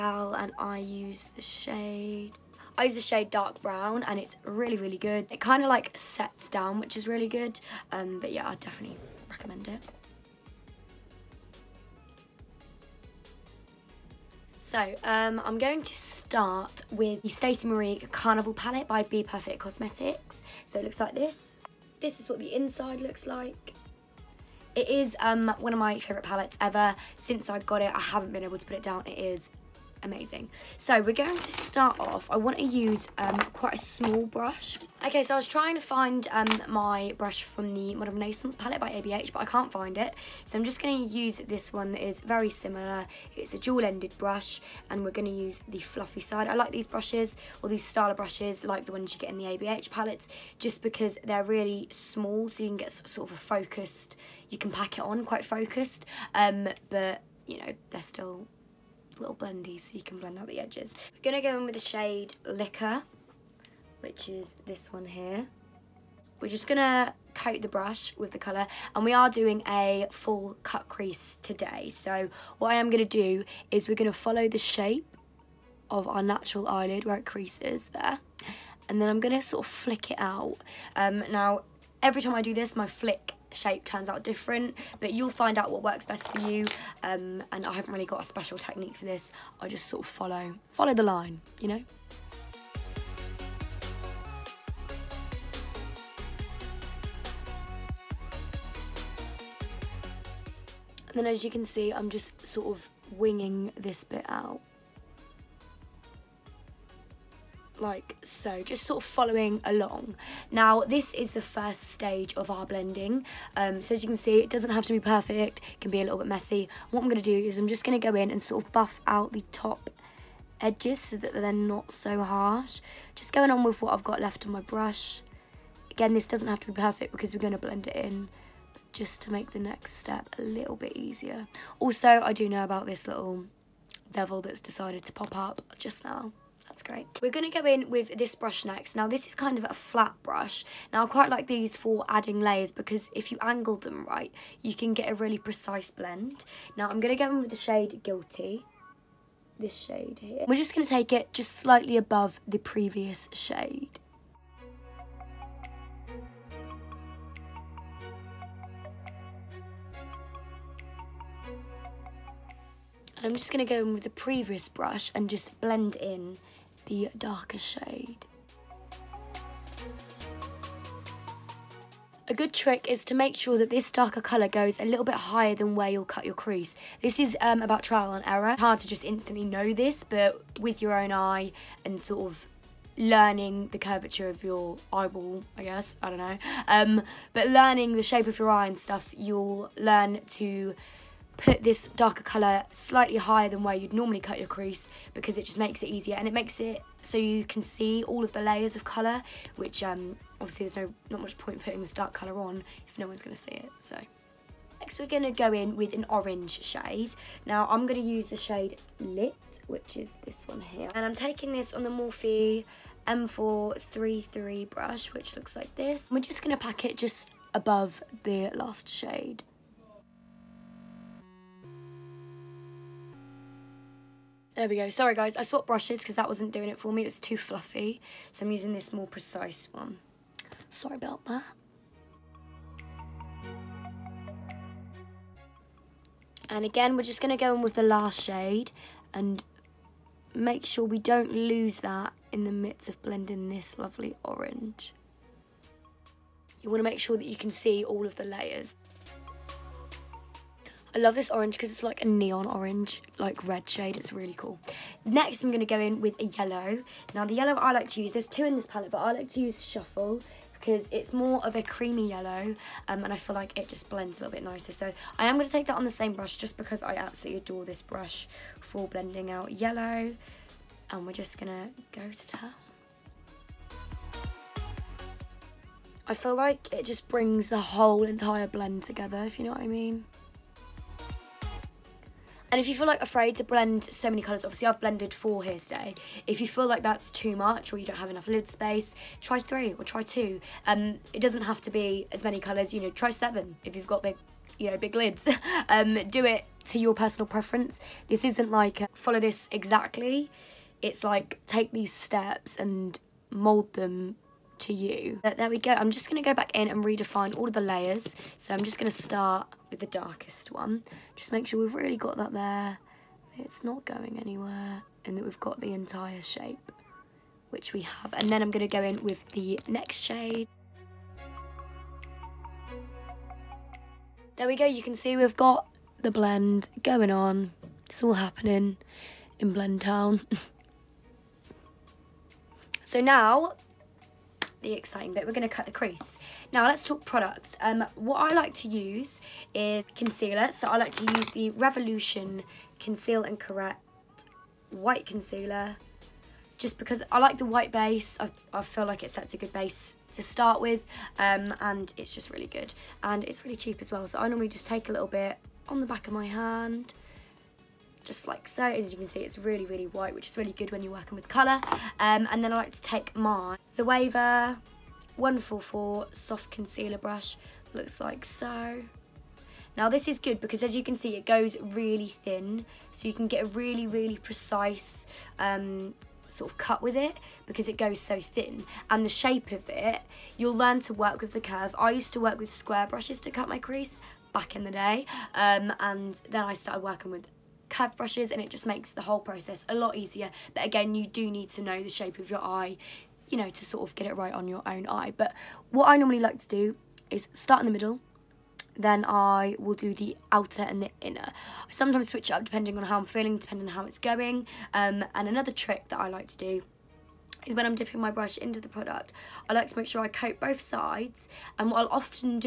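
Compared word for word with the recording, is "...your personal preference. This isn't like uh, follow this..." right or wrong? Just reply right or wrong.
right.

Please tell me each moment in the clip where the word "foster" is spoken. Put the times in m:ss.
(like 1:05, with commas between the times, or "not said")
not said.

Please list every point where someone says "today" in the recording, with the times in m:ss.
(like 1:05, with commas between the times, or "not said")
1:11, 4:45.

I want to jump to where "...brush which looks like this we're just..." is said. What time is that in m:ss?
3:34.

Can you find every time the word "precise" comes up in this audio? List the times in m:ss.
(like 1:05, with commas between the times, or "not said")
2:25, 3:49, 6:14.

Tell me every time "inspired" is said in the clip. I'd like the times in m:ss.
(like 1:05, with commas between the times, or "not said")
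not said.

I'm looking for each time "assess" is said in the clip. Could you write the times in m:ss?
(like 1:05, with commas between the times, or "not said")
not said.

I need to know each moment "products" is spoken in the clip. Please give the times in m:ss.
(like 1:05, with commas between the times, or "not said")
5:37, 6:48.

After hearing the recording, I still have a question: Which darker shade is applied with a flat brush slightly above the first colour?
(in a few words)
Guilty.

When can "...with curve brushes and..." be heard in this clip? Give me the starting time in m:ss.
6:27.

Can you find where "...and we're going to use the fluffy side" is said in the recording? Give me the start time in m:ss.
0:44.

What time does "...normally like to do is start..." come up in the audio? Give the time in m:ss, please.
6:35.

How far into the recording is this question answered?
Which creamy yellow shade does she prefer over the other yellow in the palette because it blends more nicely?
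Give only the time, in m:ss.
4:19.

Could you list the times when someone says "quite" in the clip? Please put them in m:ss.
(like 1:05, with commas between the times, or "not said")
0:33, 0:55, 2:21.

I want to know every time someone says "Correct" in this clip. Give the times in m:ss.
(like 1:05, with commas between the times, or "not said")
5:43.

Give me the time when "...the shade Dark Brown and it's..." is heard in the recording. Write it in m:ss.
0:02.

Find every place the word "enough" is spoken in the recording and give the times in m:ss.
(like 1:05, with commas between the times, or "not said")
4:48.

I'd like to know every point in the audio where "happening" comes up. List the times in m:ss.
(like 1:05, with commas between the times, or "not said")
5:28.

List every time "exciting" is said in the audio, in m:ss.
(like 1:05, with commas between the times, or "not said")
5:34.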